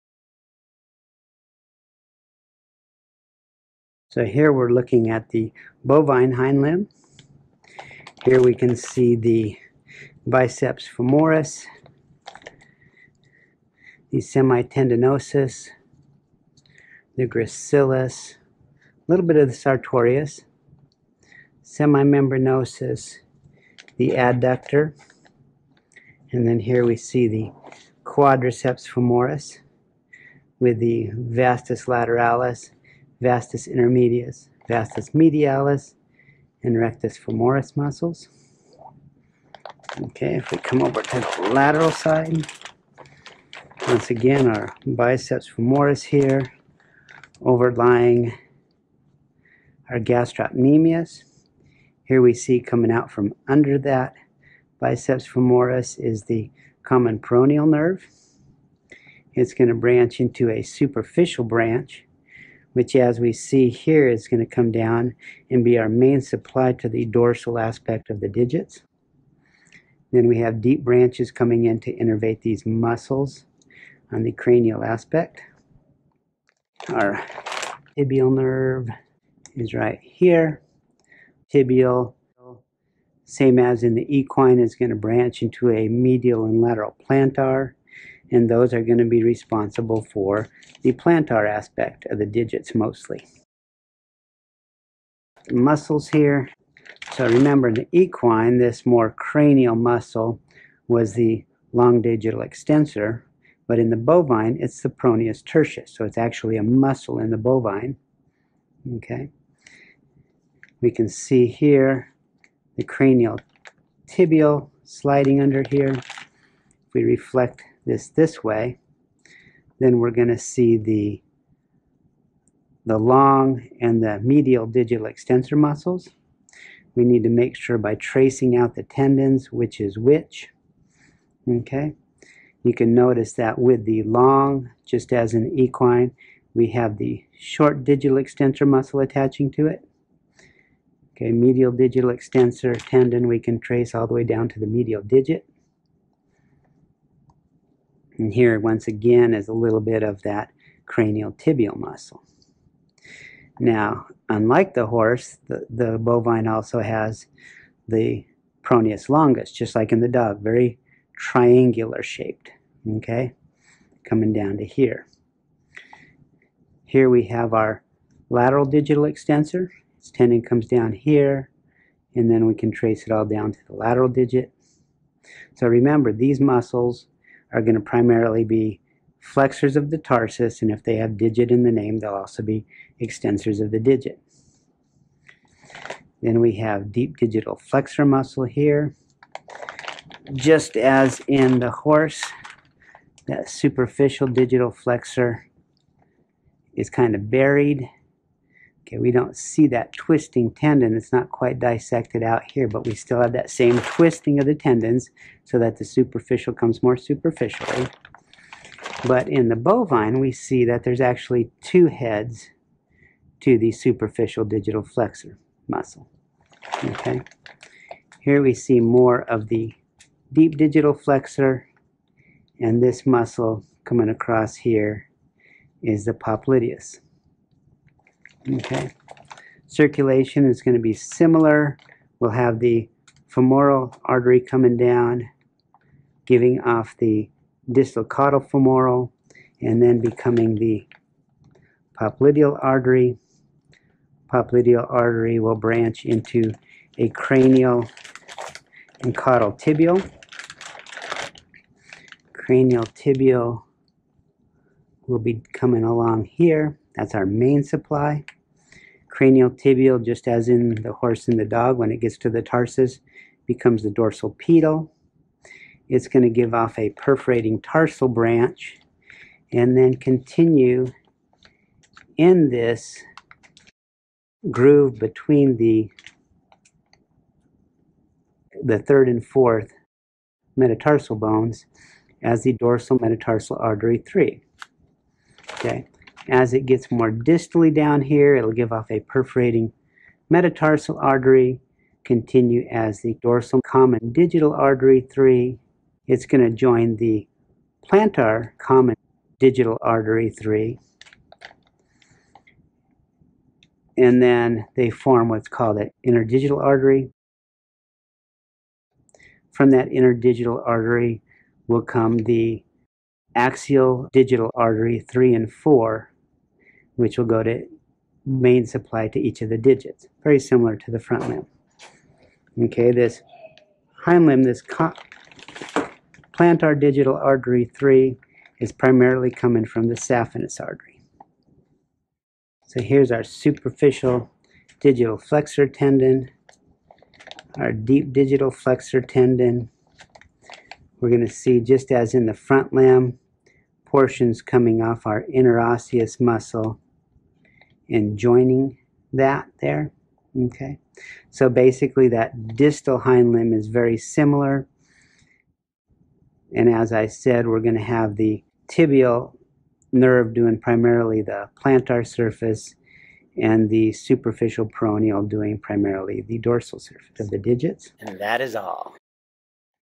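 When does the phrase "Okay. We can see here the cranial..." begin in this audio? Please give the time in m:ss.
1:48.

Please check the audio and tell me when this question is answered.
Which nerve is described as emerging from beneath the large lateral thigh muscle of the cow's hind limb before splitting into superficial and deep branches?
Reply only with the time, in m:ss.
0:56.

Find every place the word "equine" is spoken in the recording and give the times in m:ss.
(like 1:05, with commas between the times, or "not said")
1:24, 1:37, 2:15.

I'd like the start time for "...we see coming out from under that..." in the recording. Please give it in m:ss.
0:52.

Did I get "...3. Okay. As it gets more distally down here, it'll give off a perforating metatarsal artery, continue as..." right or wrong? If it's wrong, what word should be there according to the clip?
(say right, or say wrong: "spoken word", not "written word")
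right.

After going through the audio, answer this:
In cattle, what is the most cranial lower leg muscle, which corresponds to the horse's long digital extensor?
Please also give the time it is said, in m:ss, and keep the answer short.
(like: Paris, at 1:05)
Peroneus tertius, at 1:44.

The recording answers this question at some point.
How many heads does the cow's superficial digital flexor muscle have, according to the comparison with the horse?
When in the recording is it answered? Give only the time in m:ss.
3:31.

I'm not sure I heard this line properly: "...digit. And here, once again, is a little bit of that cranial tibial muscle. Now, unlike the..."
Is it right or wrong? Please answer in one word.
right.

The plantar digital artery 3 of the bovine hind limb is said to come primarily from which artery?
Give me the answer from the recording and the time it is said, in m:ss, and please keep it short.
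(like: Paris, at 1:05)
Saphenous artery, at 5:29.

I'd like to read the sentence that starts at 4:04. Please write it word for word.
Popliteal artery will branch into a cranial and caudal tibial.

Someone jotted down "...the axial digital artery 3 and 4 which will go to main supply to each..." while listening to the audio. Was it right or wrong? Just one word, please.
right.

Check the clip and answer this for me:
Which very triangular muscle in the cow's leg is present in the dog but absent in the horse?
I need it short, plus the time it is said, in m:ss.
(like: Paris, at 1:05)
Peroneus longus, at 2:38.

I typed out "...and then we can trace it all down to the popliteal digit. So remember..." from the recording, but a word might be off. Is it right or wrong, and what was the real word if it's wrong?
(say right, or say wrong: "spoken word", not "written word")
wrong: "lateral", not "popliteal".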